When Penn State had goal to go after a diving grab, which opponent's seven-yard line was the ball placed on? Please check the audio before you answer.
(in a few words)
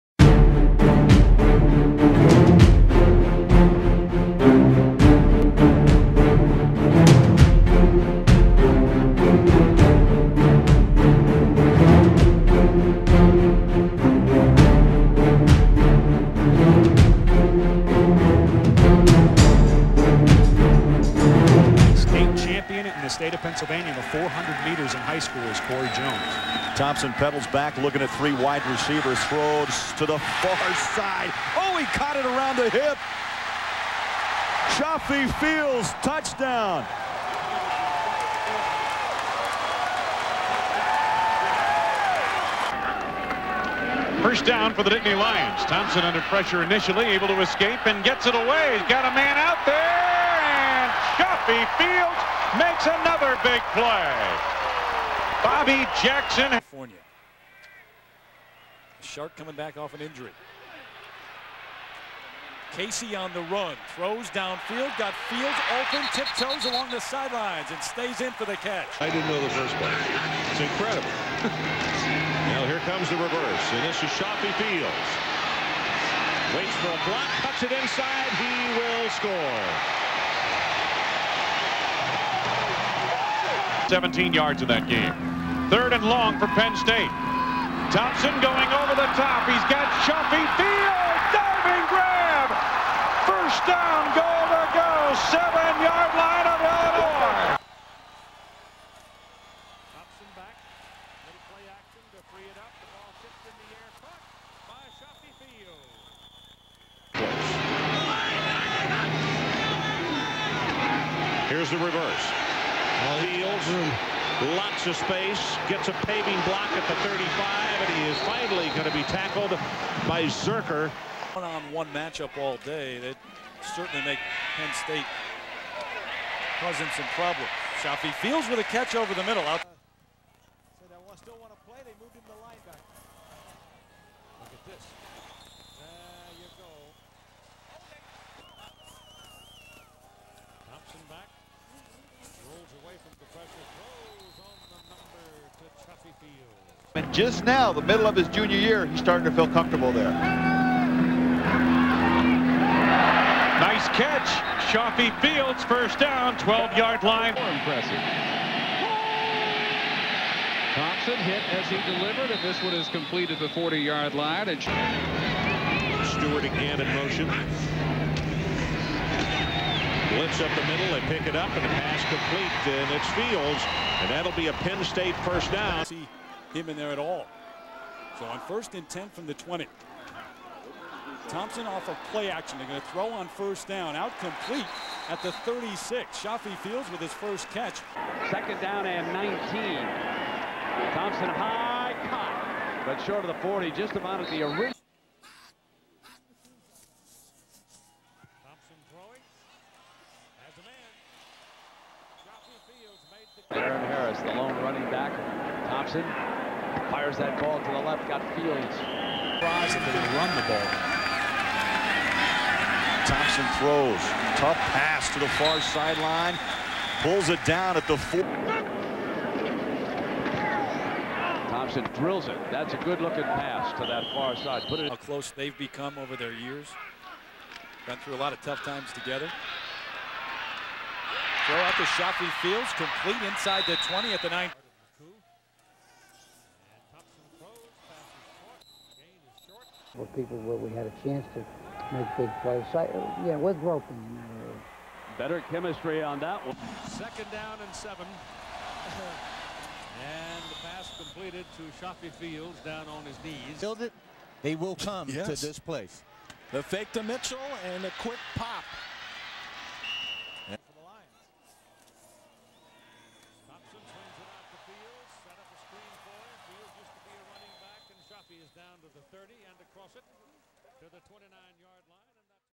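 Illinois.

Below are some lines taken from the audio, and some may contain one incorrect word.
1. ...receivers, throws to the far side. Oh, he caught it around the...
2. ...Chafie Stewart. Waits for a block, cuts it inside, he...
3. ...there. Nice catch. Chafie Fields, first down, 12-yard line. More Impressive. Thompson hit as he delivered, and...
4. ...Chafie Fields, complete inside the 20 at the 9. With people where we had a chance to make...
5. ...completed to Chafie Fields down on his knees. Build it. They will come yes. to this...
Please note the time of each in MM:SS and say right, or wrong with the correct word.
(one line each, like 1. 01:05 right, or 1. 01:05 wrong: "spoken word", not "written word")
1. 00:28 right
2. 01:14 wrong: "Fields", not "Stewart"
3. 02:29 right
4. 03:51 right
5. 04:10 right.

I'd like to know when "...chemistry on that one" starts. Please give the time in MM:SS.
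04:05.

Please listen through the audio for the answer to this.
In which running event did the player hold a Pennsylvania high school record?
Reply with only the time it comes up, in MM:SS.
00:24.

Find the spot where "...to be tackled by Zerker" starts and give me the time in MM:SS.
01:58.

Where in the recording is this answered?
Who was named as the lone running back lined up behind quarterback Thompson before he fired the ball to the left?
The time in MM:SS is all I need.
03:23.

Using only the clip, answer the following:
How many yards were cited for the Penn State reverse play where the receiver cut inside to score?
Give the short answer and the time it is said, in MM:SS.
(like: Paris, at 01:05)
17, at 01:23.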